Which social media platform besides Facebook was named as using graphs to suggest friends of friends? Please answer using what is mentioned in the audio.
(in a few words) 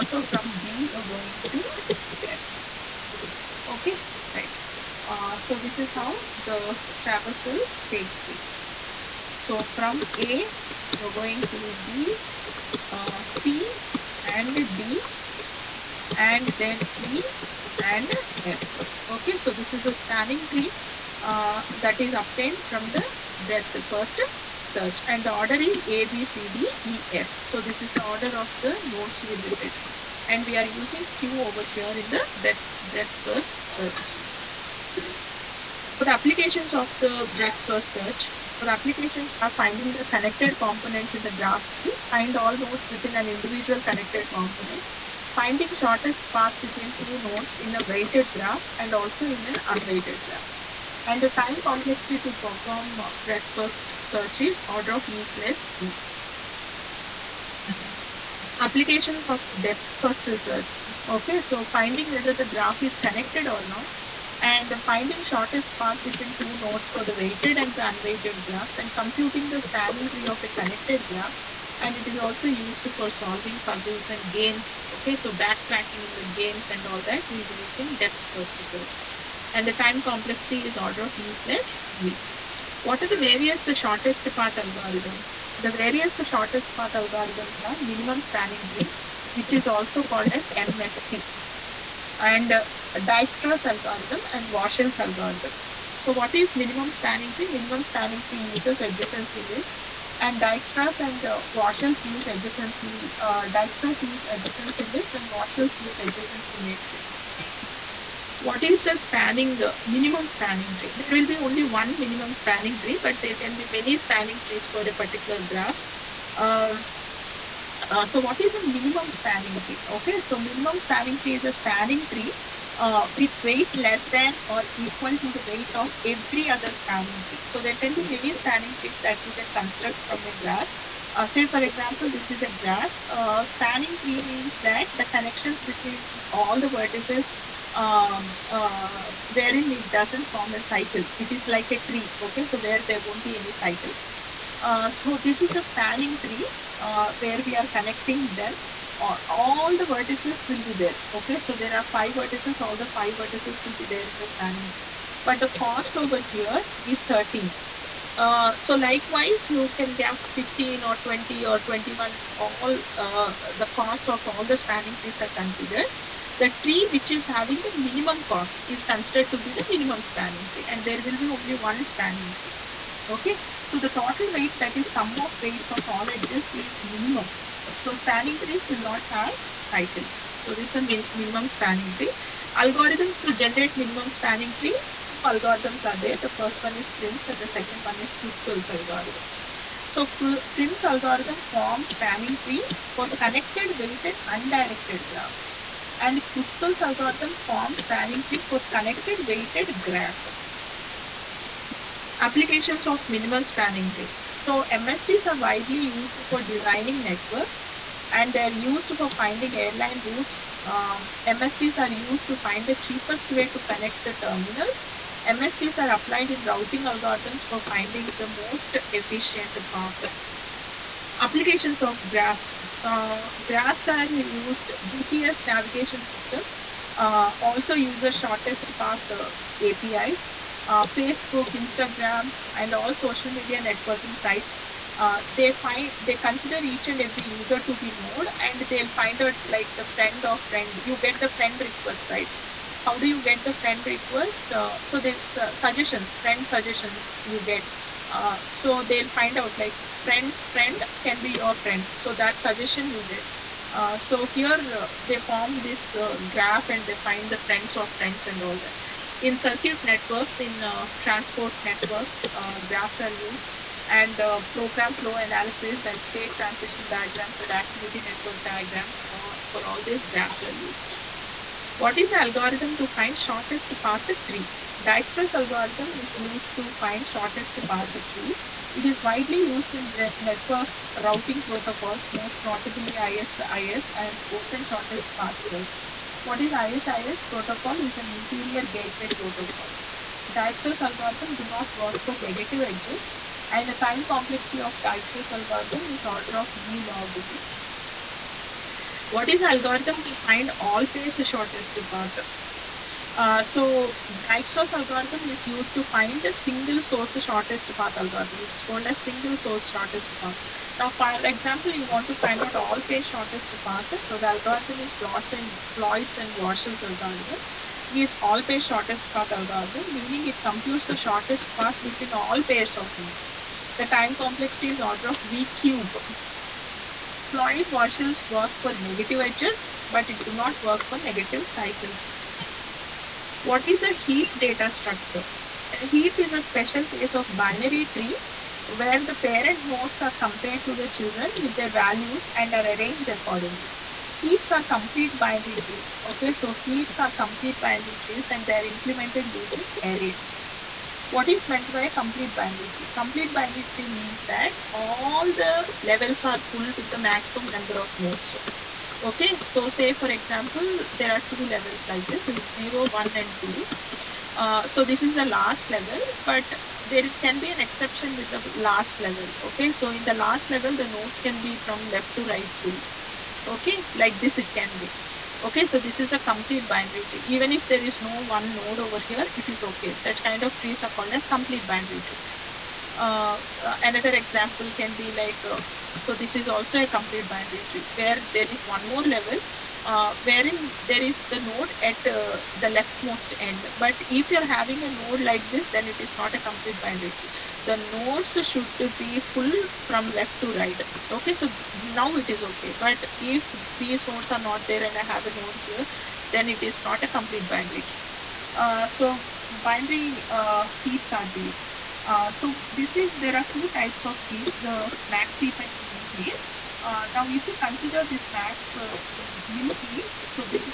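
Instagram.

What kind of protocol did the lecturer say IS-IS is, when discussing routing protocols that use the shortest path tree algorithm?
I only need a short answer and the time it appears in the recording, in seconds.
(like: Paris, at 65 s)
Interior gateway protocol, at 288 s.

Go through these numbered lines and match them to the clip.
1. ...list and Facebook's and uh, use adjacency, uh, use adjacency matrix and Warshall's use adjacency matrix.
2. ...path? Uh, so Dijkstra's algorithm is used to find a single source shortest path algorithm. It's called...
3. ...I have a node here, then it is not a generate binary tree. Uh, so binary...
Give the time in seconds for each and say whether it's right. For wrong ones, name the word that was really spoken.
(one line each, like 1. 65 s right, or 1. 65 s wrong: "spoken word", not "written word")
1. 99 s wrong: "Dijkstra", not "Facebook"
2. 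301 s right
3. 404 s wrong: "complete", not "generate".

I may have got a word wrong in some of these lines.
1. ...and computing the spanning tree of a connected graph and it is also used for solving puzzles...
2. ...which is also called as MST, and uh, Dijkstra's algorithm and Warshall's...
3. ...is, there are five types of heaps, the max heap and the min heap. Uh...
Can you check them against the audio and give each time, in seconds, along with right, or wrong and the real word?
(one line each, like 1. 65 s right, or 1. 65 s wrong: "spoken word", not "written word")
1. 68 s right
2. 89 s right
3. 412 s wrong: "two", not "five".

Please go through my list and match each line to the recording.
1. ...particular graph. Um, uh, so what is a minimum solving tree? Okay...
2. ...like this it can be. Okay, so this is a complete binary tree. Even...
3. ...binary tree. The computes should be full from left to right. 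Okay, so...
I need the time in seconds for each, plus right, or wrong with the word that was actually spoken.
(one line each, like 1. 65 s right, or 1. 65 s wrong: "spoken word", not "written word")
1. 114 s wrong: "spanning", not "solving"
2. 373 s right
3. 396 s wrong: "nodes", not "computes".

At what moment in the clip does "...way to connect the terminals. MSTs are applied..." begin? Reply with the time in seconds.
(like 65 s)
213 s.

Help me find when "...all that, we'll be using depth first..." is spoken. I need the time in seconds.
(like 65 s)
76 s.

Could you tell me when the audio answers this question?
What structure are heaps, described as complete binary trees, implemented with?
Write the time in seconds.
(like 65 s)
349 s.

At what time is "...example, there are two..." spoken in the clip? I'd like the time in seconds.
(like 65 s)
360 s.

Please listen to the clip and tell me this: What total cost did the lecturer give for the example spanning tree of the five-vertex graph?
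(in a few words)
13.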